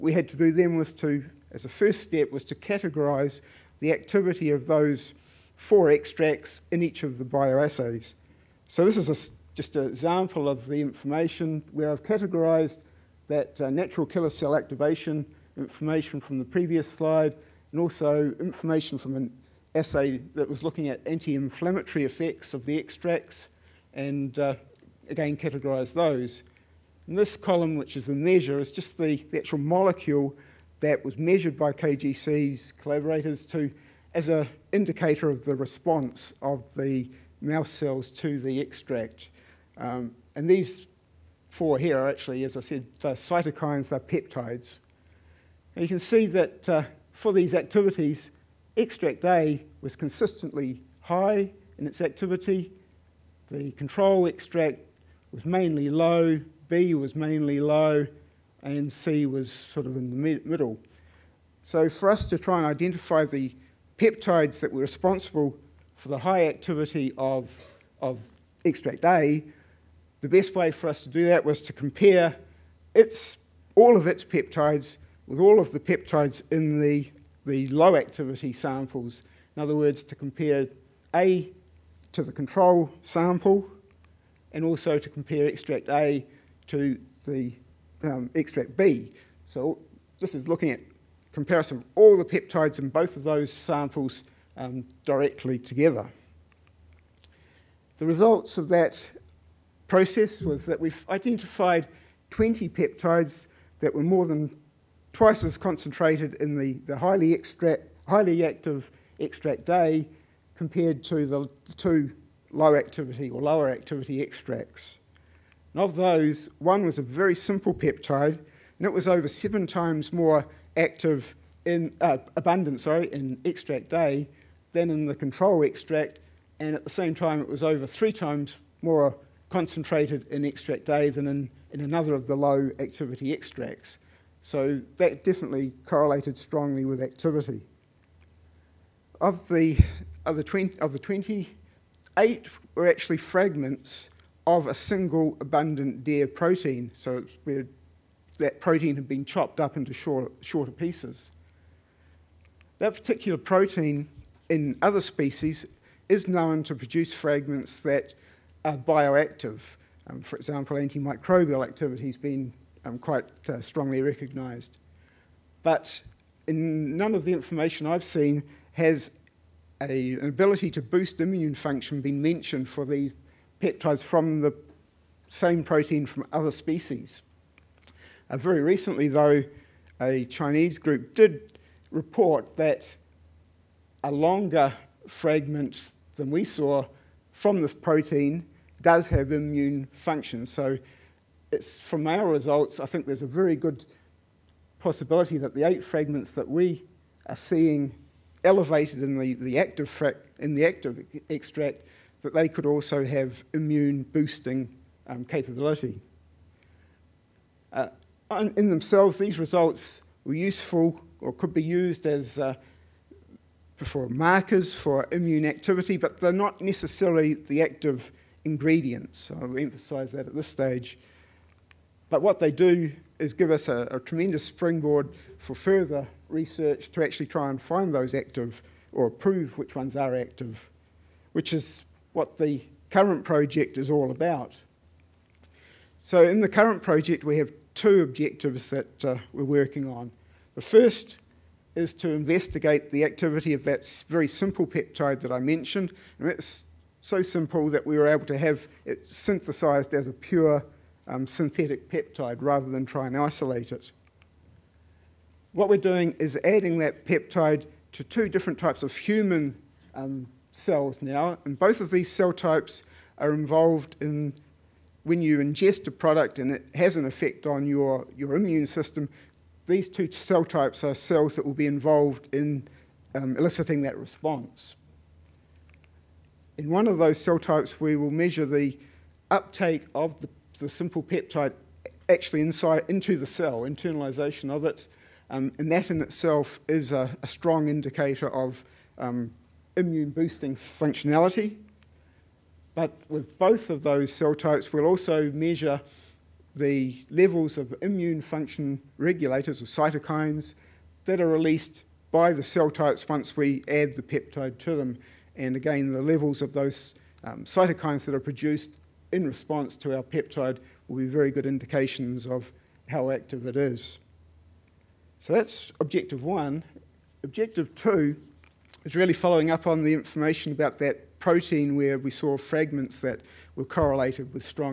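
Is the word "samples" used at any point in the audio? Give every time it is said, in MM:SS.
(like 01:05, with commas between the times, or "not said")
01:18, 01:23, 01:33.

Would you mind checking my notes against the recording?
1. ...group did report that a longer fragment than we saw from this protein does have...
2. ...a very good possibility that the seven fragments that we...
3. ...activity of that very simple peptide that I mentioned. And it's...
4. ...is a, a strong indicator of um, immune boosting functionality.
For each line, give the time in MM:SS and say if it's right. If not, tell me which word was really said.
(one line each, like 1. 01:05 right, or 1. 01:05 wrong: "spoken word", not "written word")
1. 03:00 right
2. 03:13 wrong: "eight", not "seven"
3. 04:03 right
4. 04:46 right.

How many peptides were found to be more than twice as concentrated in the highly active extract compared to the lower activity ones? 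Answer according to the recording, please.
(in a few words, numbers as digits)
20.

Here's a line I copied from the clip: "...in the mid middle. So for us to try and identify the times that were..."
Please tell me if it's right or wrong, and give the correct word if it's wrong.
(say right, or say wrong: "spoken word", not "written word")
wrong: "peptides", not "times".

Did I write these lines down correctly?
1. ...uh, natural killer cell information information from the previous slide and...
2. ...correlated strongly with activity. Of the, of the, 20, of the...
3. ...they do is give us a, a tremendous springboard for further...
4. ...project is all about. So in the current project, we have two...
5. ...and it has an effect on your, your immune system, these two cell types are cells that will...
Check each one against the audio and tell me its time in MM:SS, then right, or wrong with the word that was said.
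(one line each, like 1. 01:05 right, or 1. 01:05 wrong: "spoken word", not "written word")
1. 00:13 wrong: "activation", not "information"
2. 02:15 right
3. 03:42 right
4. 03:53 right
5. 04:26 right.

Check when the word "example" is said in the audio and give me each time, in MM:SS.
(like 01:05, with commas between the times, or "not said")
00:09, 02:40.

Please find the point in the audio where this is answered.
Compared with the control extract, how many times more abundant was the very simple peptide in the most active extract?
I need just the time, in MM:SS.
01:59.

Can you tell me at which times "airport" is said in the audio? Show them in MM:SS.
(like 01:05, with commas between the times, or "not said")
not said.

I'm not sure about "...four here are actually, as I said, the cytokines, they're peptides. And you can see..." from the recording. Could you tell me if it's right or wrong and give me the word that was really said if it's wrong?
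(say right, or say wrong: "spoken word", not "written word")
right.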